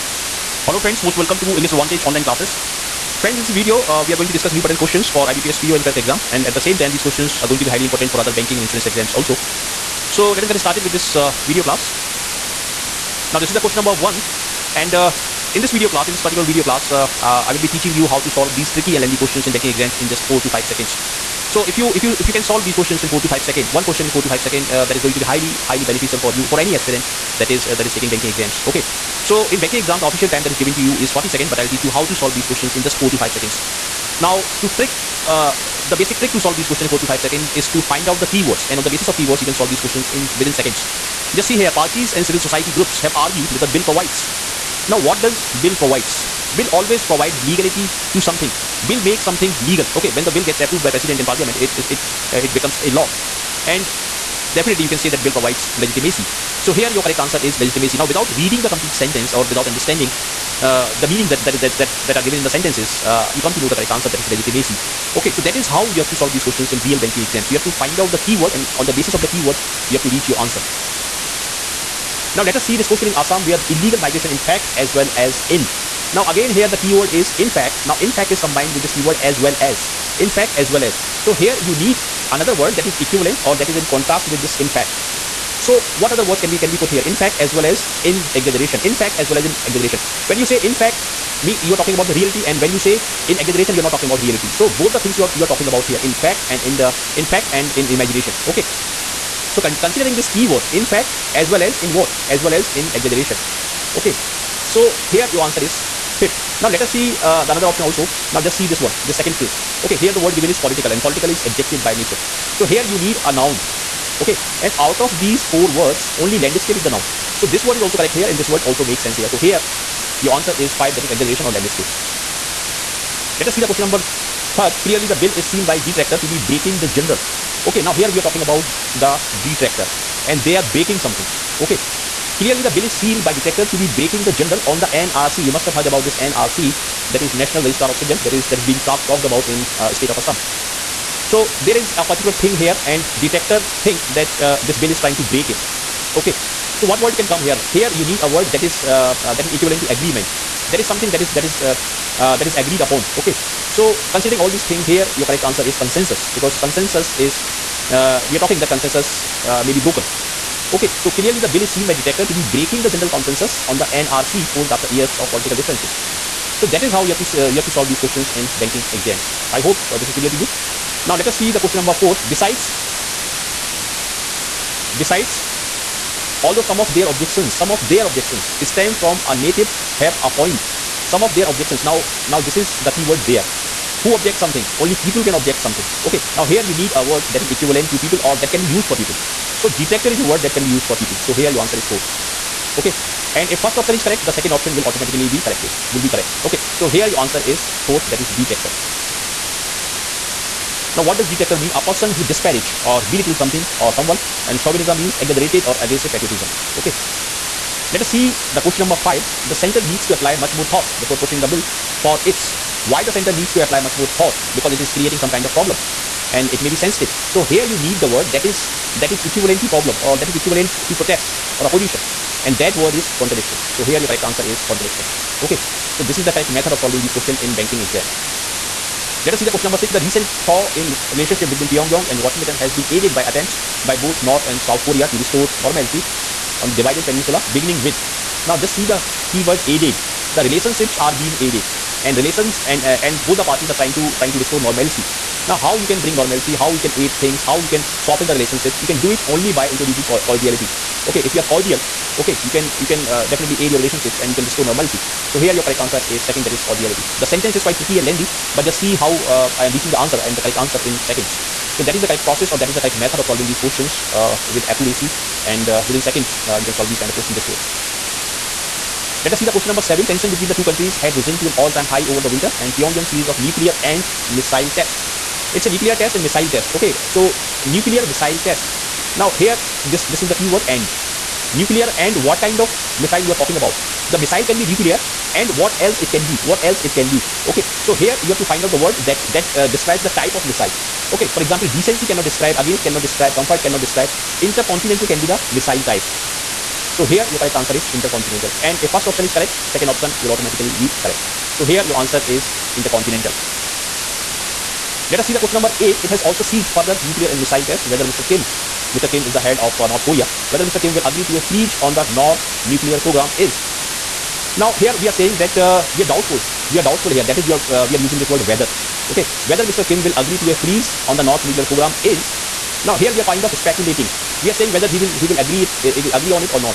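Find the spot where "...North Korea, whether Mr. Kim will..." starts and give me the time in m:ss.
5:09.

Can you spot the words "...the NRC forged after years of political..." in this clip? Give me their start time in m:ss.
2:43.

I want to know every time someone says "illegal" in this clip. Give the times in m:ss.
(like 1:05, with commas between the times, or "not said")
1:13.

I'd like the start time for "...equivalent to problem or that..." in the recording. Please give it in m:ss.
3:39.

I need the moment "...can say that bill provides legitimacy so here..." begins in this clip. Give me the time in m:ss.
0:54.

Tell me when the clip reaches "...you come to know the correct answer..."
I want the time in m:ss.
1:03.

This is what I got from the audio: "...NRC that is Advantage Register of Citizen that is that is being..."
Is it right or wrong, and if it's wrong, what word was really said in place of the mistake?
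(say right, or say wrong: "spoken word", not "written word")
wrong: "National", not "Advantage".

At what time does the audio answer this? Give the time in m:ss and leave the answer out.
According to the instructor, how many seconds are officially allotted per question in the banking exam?
0:31.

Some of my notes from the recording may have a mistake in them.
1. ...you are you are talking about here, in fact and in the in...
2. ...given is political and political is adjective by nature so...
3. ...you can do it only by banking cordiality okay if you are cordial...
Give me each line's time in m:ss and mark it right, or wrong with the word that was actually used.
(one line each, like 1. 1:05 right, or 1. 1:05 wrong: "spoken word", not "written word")
1. 1:35 right
2. 1:50 right
3. 4:08 wrong: "introducing", not "banking".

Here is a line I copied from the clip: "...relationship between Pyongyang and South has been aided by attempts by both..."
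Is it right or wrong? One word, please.
wrong.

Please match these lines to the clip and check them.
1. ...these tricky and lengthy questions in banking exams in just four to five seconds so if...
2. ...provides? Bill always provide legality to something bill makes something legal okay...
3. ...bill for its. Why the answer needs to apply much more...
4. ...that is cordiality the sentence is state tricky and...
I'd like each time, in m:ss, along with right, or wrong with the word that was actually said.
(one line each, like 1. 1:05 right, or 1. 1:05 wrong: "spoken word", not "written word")
1. 0:18 right
2. 0:45 right
3. 3:31 wrong: "center", not "answer"
4. 4:16 wrong: "quite", not "state".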